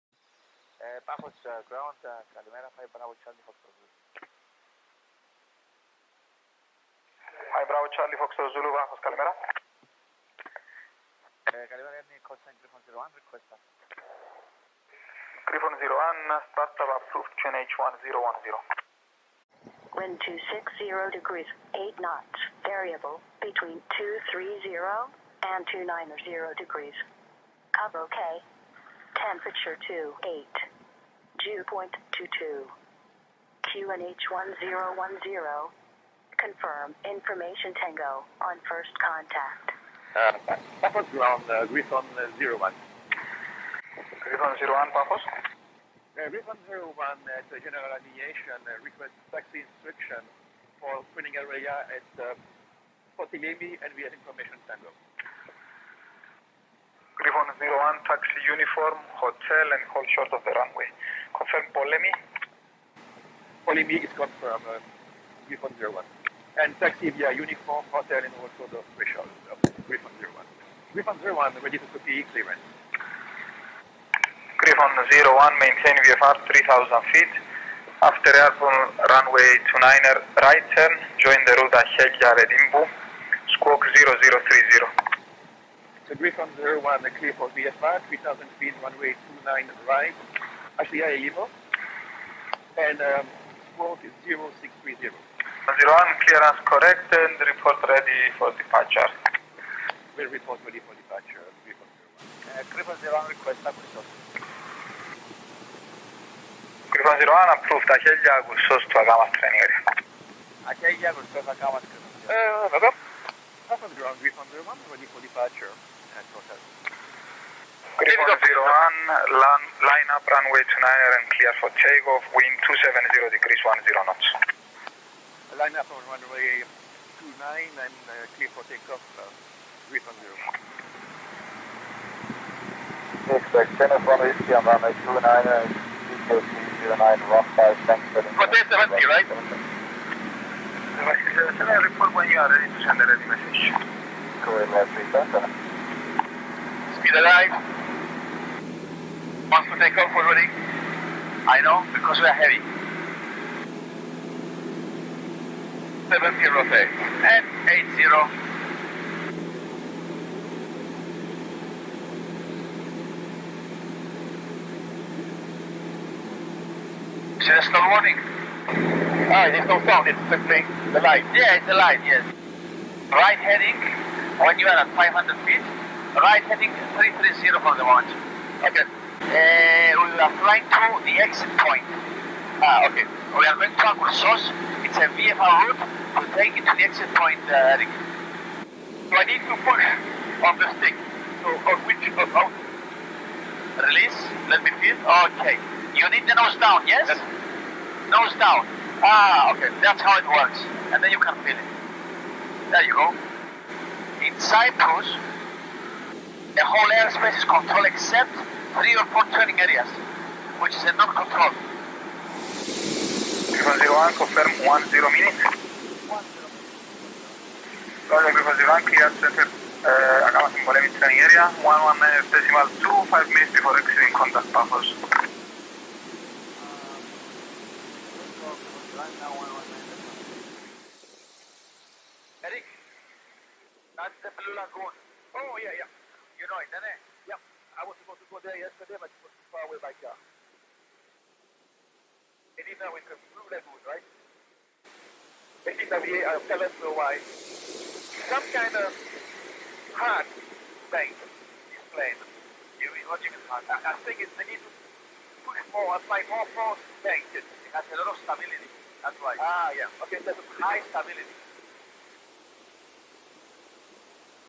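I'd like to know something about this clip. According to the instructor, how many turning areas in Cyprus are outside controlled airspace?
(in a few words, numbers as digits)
three or four.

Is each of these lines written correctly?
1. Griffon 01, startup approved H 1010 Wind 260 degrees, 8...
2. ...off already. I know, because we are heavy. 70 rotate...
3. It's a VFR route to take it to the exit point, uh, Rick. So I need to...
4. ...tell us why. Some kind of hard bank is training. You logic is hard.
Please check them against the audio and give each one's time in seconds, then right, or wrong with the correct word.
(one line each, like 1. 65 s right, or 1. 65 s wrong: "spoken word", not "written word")
1. 15 s right
2. 149 s right
3. 184 s right
4. 246 s wrong: "playing", not "training".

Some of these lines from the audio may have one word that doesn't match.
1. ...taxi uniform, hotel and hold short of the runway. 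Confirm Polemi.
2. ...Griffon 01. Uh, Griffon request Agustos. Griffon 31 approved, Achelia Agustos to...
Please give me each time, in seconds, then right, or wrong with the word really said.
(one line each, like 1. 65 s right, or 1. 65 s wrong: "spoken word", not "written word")
1. 58 s right
2. 101 s wrong: "01", not "31".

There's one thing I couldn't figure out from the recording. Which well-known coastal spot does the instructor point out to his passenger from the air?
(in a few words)
Blue Lagoon.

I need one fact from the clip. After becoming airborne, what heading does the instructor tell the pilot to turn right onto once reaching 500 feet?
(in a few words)
330.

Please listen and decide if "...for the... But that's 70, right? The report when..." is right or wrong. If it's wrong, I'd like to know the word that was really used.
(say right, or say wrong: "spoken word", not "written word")
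right.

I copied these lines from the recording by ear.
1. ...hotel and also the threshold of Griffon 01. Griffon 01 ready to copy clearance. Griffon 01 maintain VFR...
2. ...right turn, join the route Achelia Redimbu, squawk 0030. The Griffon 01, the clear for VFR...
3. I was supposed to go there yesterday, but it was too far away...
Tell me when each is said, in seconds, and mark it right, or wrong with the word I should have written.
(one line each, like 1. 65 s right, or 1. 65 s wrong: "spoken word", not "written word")
1. 67 s right
2. 80 s right
3. 237 s right.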